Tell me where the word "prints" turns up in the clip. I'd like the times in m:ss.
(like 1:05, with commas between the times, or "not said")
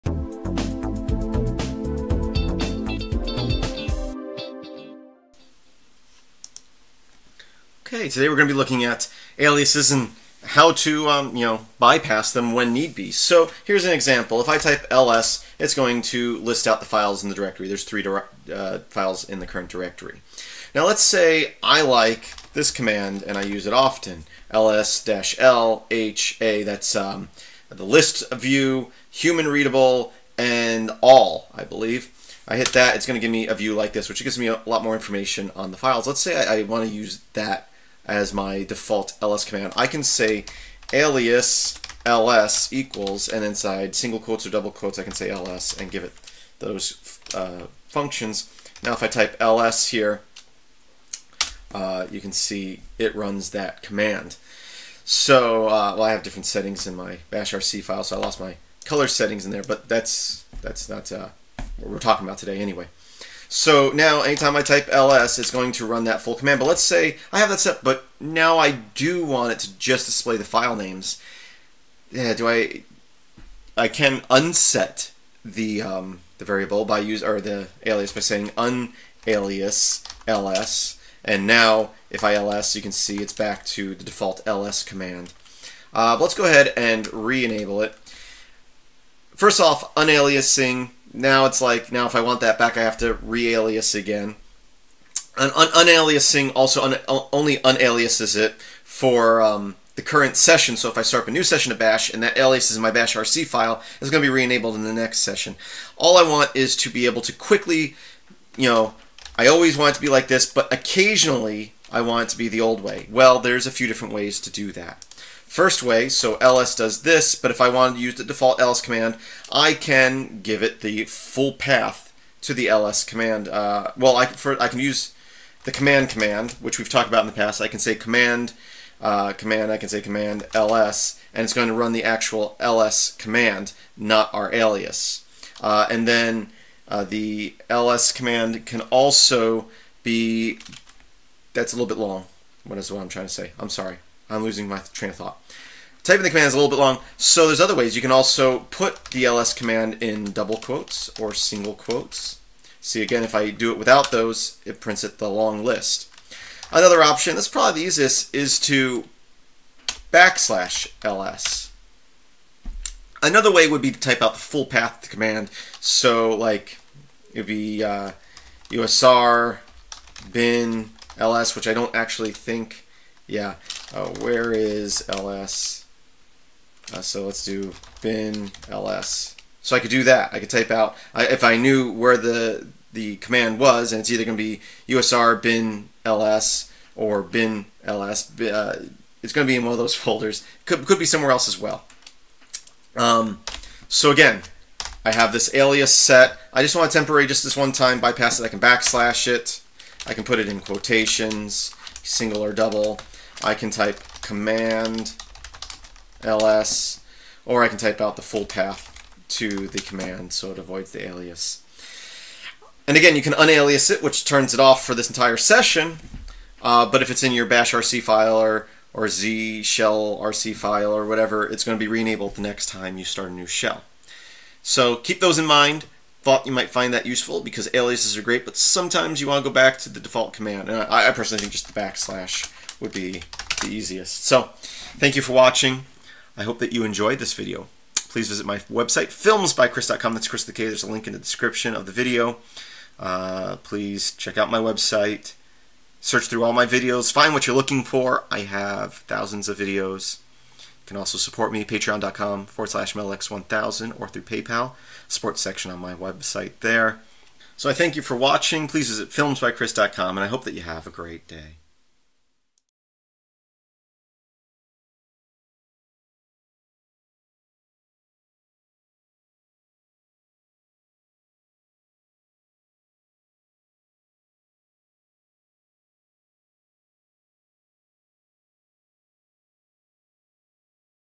2:34.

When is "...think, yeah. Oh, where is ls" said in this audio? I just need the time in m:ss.
2:52.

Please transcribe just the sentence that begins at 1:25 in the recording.
Uh, but let's go ahead and re-enable it.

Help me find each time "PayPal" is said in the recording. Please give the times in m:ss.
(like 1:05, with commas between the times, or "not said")
4:14.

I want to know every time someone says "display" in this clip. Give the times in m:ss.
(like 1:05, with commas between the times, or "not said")
1:10.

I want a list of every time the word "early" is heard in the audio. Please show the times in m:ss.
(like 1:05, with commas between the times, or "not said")
not said.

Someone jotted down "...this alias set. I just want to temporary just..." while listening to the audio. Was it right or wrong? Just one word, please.
right.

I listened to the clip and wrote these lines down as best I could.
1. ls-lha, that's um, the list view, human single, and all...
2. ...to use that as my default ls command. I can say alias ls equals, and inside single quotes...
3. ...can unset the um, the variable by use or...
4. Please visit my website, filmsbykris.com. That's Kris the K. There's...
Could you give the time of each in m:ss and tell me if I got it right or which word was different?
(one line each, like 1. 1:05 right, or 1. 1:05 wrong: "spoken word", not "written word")
1. 0:24 wrong: "readable", not "single"
2. 0:36 right
3. 1:13 right
4. 3:58 right.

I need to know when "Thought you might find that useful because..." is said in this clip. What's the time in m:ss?
3:46.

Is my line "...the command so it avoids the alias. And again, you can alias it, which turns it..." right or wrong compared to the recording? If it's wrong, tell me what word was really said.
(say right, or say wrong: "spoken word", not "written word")
wrong: "unalias", not "alias".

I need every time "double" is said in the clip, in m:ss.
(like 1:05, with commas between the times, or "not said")
0:44, 2:30, 3:22.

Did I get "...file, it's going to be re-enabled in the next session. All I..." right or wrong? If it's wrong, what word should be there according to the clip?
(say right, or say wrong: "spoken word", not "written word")
right.